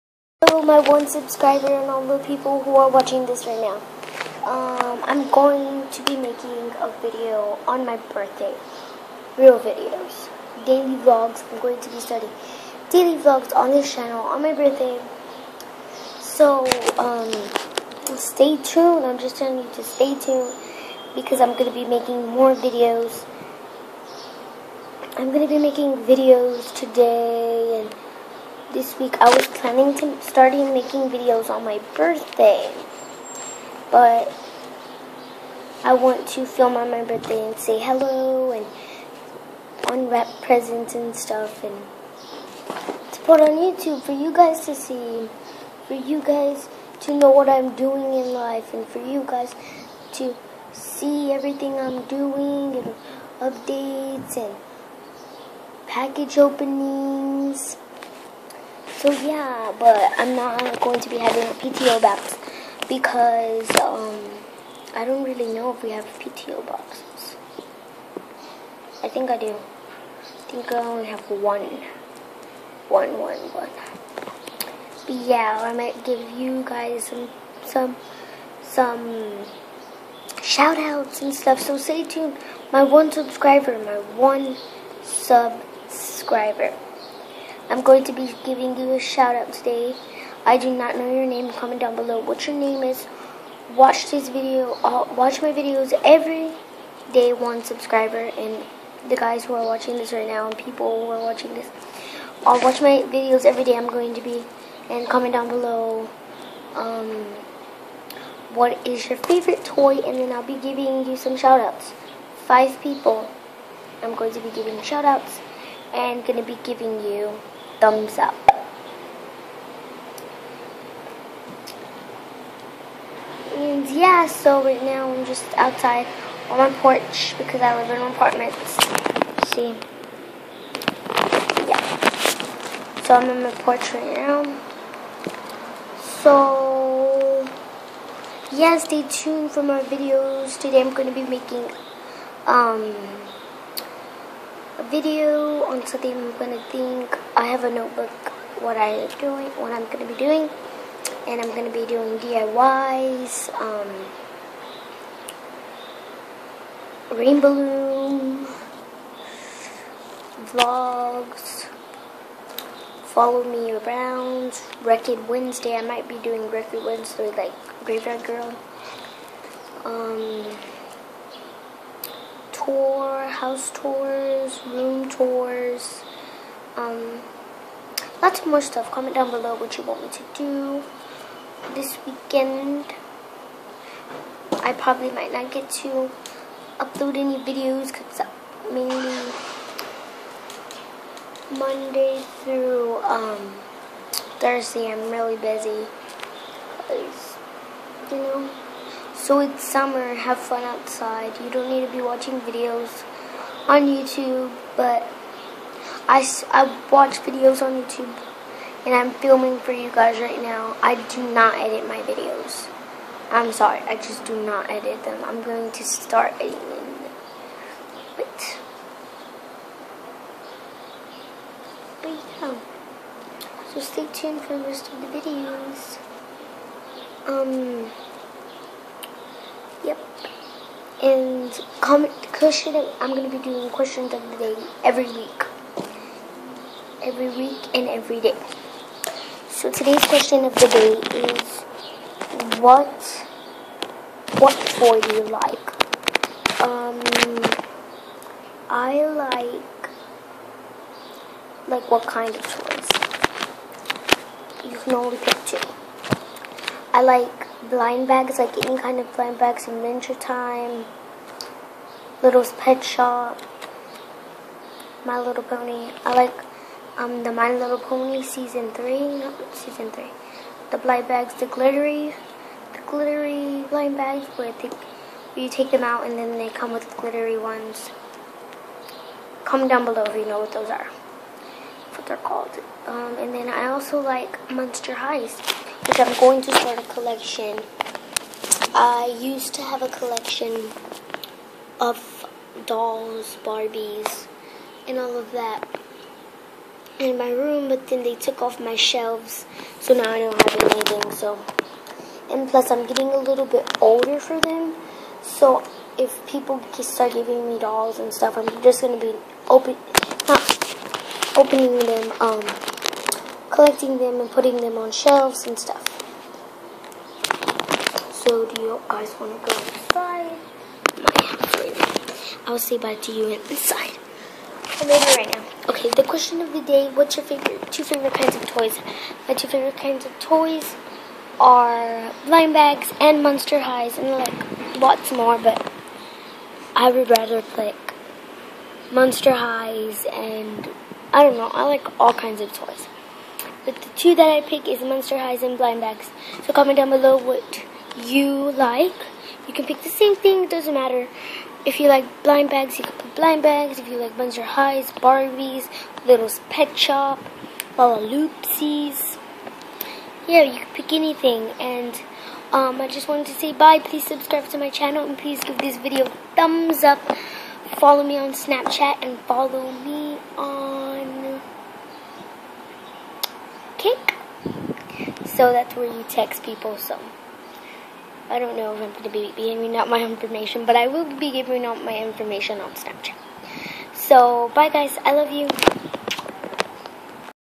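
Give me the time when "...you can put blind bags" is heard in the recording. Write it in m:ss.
5:52.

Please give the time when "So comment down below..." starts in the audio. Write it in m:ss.
5:46.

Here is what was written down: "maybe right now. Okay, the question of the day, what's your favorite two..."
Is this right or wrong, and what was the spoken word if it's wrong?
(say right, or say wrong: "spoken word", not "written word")
right.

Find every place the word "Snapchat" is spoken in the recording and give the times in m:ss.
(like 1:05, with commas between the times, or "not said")
6:08, 6:22.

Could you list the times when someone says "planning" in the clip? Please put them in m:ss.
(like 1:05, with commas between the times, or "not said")
0:29.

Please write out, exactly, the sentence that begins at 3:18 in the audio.
You know, so it's summer, have fun outside.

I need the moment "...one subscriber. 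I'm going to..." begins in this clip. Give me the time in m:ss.
1:24.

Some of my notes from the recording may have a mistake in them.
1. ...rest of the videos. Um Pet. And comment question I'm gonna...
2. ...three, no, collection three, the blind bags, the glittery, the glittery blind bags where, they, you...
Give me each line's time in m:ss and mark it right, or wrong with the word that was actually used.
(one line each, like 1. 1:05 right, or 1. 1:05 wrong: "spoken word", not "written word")
1. 3:44 wrong: "Yep", not "Pet"
2. 4:28 wrong: "season", not "collection".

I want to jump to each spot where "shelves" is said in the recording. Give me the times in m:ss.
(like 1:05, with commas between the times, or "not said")
4:58, 5:14.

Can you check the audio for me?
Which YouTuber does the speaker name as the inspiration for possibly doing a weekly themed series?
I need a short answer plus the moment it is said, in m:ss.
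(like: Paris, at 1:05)
Graveyard Girl, at 2:47.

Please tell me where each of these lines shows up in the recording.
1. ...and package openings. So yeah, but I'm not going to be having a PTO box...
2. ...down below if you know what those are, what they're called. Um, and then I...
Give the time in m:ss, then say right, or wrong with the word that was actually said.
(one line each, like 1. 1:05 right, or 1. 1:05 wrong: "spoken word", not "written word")
1. 0:54 right
2. 4:39 right.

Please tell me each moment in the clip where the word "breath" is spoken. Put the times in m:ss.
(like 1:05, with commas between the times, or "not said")
not said.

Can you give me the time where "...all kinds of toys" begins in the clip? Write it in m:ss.
5:41.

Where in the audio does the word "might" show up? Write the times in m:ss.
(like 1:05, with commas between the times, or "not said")
1:15, 2:45, 3:05.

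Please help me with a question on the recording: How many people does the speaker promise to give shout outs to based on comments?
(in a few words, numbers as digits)
5.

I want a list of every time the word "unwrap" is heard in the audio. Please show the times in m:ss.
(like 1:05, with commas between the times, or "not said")
0:39.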